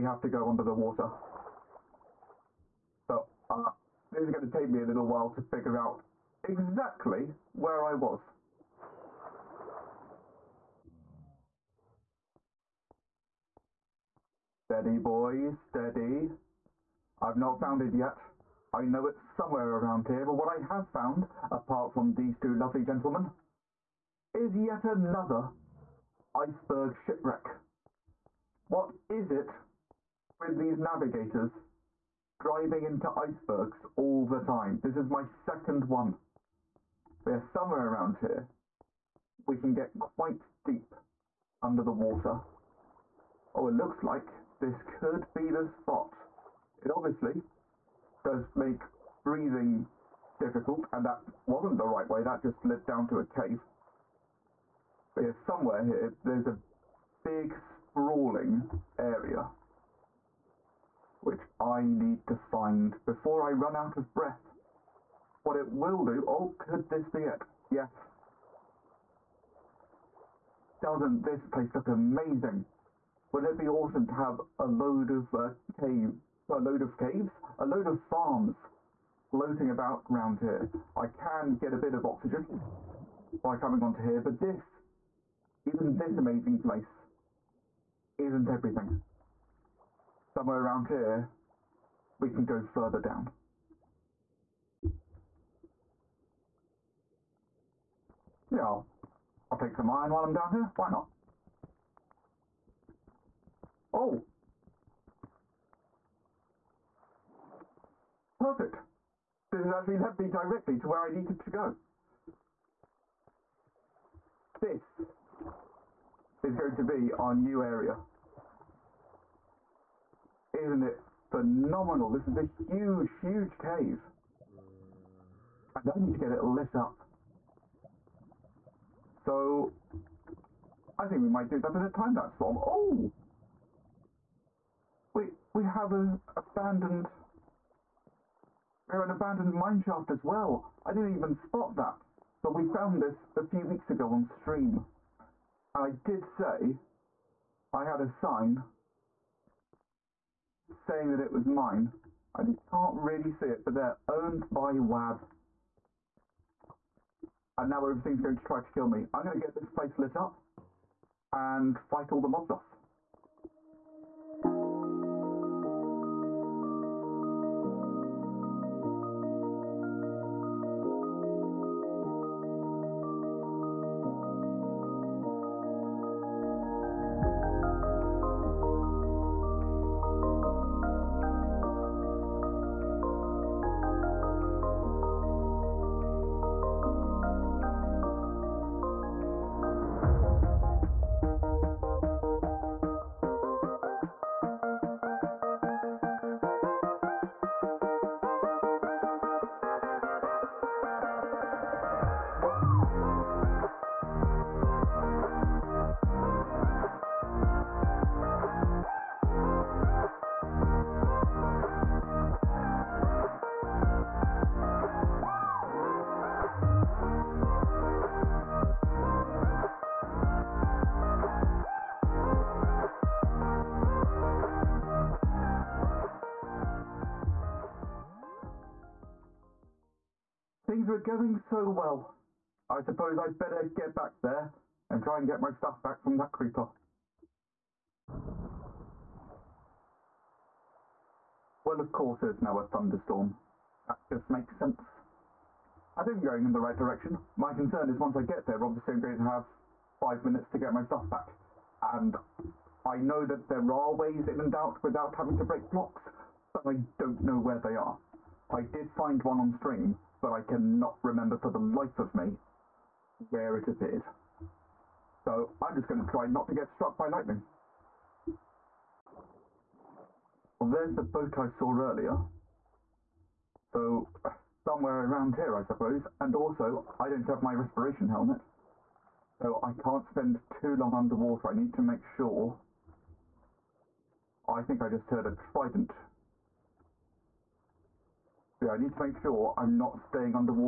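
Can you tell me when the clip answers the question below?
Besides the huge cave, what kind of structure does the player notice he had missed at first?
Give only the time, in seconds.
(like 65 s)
139 s.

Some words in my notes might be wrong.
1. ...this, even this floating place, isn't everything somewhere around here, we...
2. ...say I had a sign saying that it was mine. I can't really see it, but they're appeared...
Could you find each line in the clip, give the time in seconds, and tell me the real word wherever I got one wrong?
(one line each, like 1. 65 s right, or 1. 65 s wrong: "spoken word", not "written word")
1. 84 s wrong: "amazing", not "floating"
2. 146 s wrong: "owned", not "appeared".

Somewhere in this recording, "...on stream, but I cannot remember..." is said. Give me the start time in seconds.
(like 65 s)
259 s.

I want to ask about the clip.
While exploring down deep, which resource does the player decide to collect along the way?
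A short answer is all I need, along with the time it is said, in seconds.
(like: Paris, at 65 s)
Iron, at 99 s.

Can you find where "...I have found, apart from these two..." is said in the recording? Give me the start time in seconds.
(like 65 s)
20 s.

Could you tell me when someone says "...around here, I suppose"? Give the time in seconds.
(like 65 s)
275 s.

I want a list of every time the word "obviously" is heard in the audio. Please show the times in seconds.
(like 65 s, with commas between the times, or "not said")
46 s, 248 s.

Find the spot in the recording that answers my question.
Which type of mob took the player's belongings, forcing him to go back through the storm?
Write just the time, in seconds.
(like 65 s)
236 s.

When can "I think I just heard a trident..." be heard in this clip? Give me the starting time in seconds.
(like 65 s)
284 s.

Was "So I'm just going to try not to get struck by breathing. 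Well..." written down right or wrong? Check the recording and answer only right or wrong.
wrong.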